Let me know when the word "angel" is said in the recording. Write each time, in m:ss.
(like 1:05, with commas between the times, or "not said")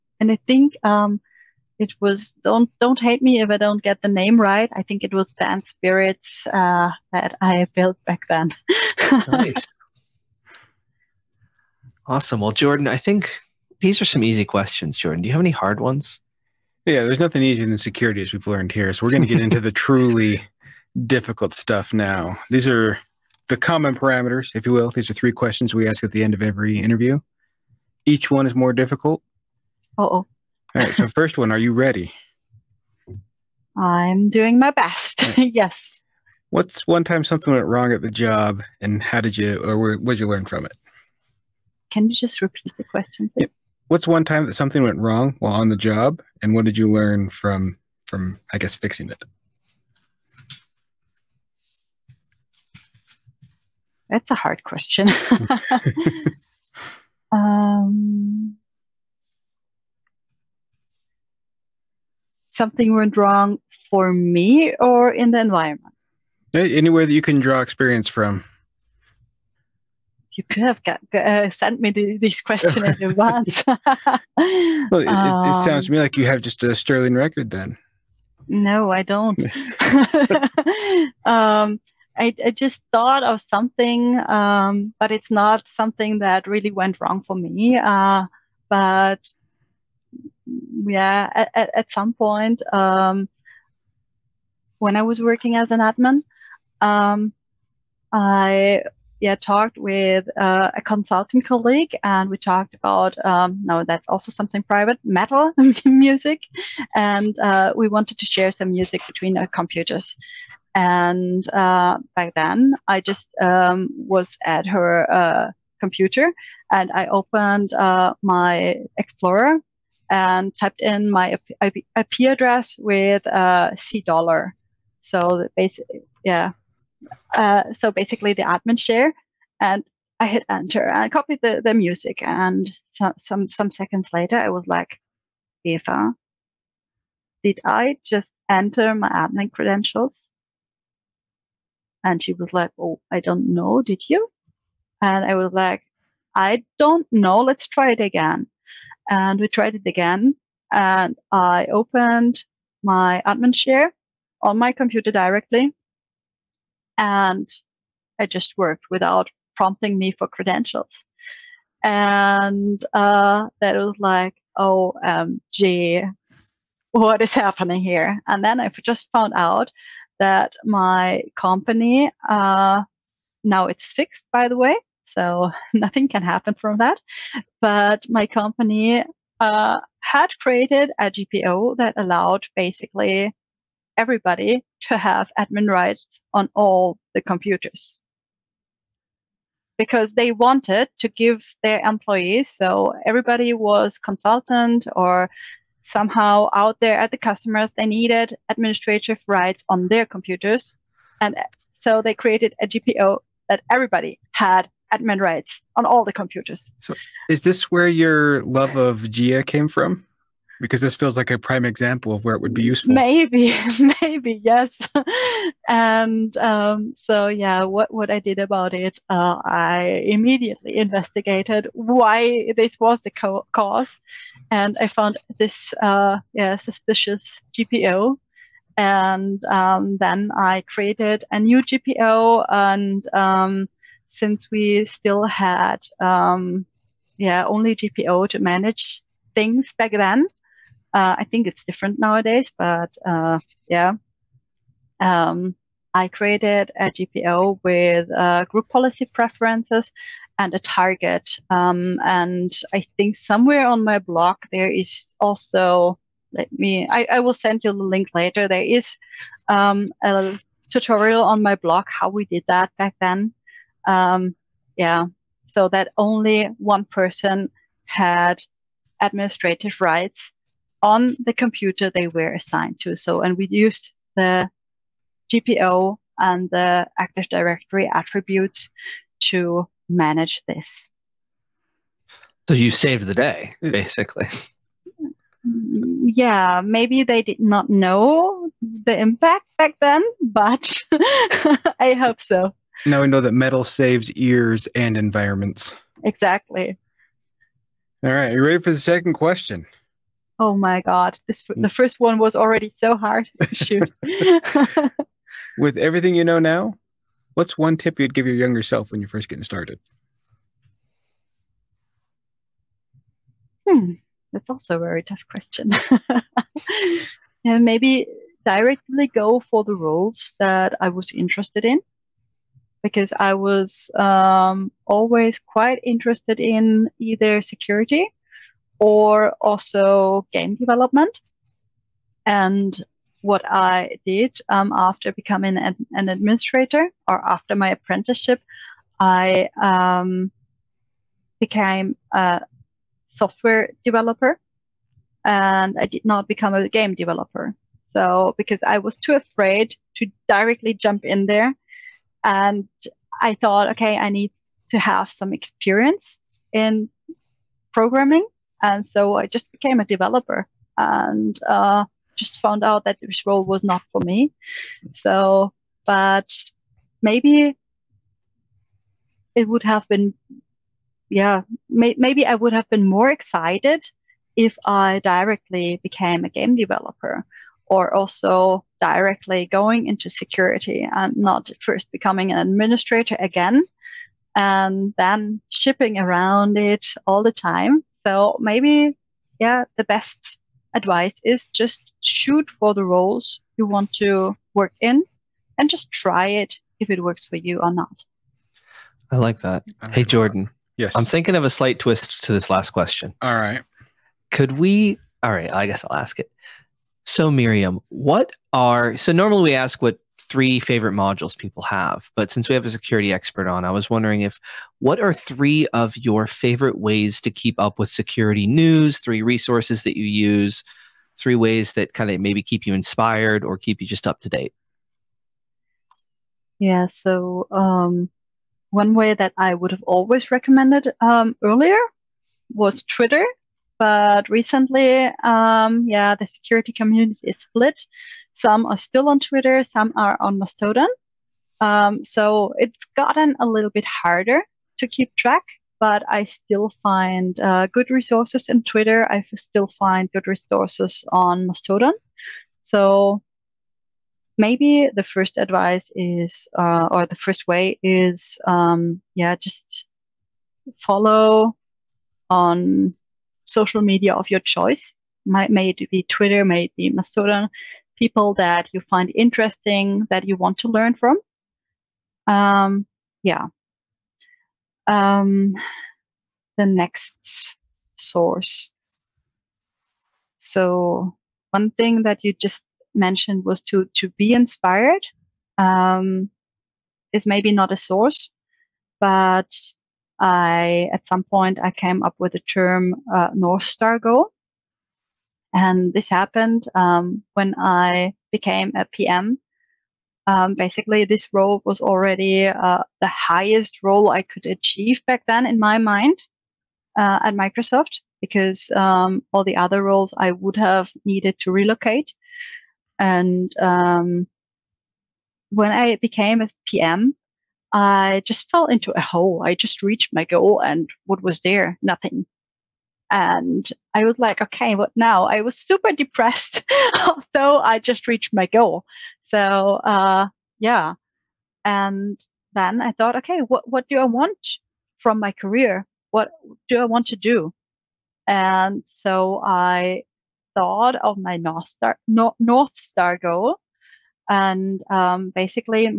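not said.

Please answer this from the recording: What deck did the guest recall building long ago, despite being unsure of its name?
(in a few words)
Bant Spirits.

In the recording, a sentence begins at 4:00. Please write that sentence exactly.
Uh, I think it's different nowadays, but uh, yeah.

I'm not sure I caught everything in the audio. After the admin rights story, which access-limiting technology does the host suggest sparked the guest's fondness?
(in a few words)
JEA.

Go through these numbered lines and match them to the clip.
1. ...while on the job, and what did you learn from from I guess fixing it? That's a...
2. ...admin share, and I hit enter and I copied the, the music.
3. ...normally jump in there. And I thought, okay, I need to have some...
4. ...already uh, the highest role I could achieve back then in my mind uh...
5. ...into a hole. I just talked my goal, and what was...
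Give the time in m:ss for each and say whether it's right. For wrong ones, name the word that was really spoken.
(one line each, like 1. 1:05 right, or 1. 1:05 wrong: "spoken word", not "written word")
1. 0:45 right
2. 2:08 right
3. 5:50 wrong: "directly", not "normally"
4. 8:21 right
5. 8:38 wrong: "reached", not "talked".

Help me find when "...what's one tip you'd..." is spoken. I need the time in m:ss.
5:07.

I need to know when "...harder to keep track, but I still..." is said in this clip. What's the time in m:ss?
7:23.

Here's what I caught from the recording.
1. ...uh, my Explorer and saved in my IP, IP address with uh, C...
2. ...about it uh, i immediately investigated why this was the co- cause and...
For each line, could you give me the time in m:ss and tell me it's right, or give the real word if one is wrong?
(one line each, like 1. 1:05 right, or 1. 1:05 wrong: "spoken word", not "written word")
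1. 1:57 wrong: "typed", not "saved"
2. 3:38 right.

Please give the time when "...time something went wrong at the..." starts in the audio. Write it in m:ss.
0:37.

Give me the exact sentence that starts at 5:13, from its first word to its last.
Hmm, that's also a very tough question.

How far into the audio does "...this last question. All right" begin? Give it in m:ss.
6:42.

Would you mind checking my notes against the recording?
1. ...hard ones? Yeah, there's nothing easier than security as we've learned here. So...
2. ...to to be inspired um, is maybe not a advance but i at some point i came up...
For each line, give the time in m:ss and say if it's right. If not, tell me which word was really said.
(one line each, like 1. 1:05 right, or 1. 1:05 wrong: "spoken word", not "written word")
1. 0:15 right
2. 8:03 wrong: "source", not "advance".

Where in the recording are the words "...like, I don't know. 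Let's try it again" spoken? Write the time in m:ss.
2:25.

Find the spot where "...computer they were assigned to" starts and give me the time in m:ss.
4:31.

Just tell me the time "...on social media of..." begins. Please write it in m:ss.
7:42.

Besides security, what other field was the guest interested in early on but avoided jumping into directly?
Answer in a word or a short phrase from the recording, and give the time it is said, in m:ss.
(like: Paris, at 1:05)
Game development, at 5:30.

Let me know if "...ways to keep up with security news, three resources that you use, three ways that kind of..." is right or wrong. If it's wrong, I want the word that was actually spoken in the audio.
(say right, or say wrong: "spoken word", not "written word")
right.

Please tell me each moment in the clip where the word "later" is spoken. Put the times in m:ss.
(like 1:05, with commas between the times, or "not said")
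2:14, 4:18.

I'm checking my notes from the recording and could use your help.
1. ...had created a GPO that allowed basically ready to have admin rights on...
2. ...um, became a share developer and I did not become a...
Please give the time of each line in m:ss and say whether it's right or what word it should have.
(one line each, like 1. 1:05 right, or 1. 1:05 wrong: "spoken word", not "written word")
1. 2:59 wrong: "everybody", not "ready"
2. 5:39 wrong: "software", not "share".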